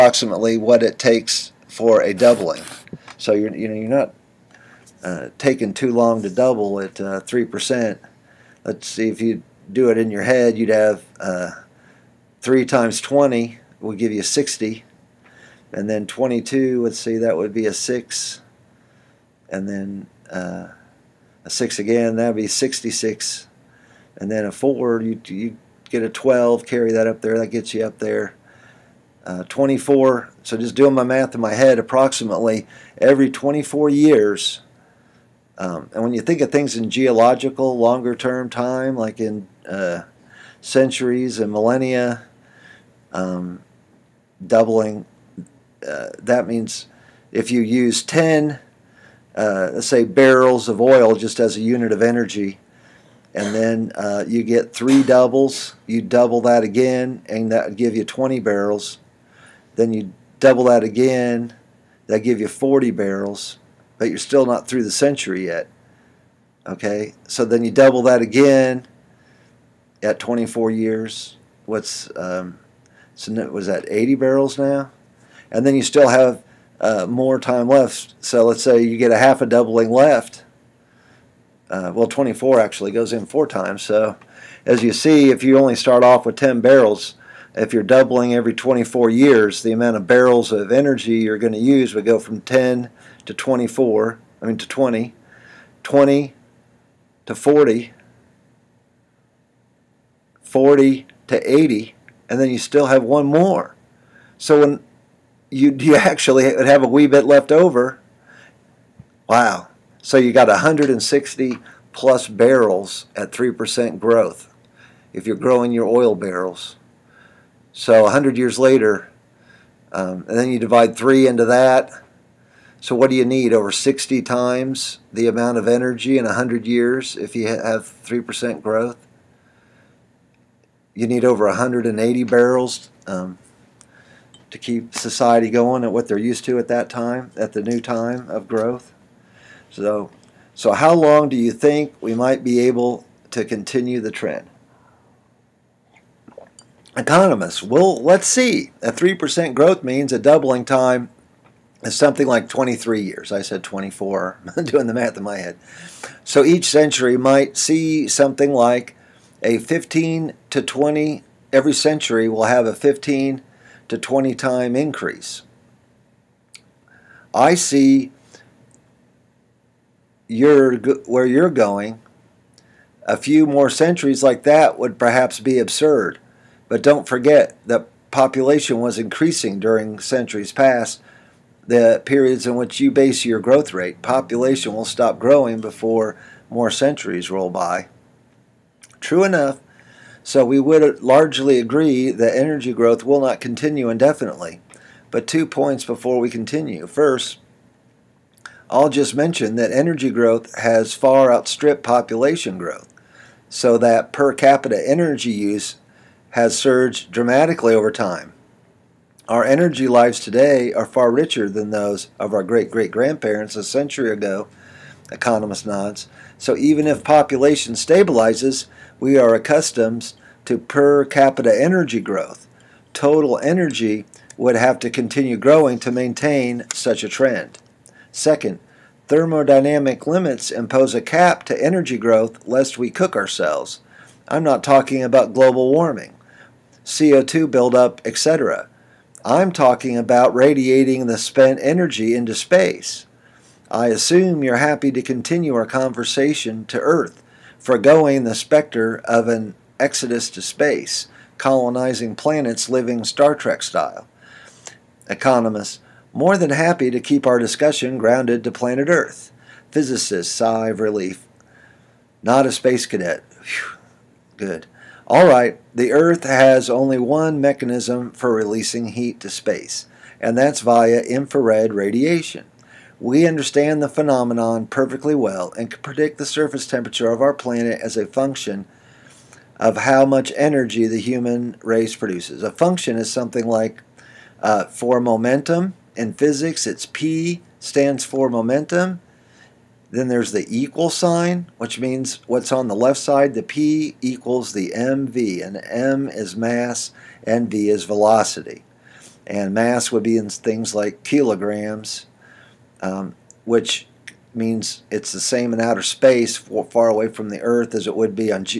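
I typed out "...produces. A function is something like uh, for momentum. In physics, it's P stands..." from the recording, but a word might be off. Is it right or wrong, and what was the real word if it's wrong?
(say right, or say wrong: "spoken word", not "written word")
right.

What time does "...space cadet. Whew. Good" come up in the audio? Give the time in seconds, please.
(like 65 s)
262 s.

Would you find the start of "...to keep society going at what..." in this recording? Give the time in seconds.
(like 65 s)
134 s.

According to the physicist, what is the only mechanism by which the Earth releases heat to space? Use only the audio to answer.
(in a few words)
infrared radiation.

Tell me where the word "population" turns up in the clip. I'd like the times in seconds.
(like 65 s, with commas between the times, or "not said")
178 s, 184 s, 201 s, 217 s.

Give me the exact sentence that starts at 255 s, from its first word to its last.
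Economists, more than happy to keep our discussion grounded to planet Earth.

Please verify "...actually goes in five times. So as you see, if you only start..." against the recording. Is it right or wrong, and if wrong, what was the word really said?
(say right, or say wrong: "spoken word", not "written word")
wrong: "four", not "five".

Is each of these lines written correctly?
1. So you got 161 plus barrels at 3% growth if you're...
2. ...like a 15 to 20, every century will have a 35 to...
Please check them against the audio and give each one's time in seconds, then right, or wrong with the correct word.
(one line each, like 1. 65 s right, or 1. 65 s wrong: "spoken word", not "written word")
1. 110 s wrong: "160", not "161"
2. 158 s wrong: "15", not "35".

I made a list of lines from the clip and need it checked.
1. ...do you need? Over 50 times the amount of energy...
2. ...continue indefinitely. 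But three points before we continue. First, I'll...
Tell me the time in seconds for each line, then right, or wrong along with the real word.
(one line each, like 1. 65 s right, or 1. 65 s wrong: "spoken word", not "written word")
1. 123 s wrong: "60", not "50"
2. 193 s wrong: "two", not "three".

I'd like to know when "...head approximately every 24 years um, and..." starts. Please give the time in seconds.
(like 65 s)
31 s.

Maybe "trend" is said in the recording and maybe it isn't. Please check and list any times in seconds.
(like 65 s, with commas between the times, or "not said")
144 s, 227 s.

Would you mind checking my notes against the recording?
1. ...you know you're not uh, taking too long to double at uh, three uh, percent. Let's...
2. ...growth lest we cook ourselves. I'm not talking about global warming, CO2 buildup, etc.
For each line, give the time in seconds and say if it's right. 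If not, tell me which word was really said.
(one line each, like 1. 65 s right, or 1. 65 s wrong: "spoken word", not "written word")
1. 3 s right
2. 231 s right.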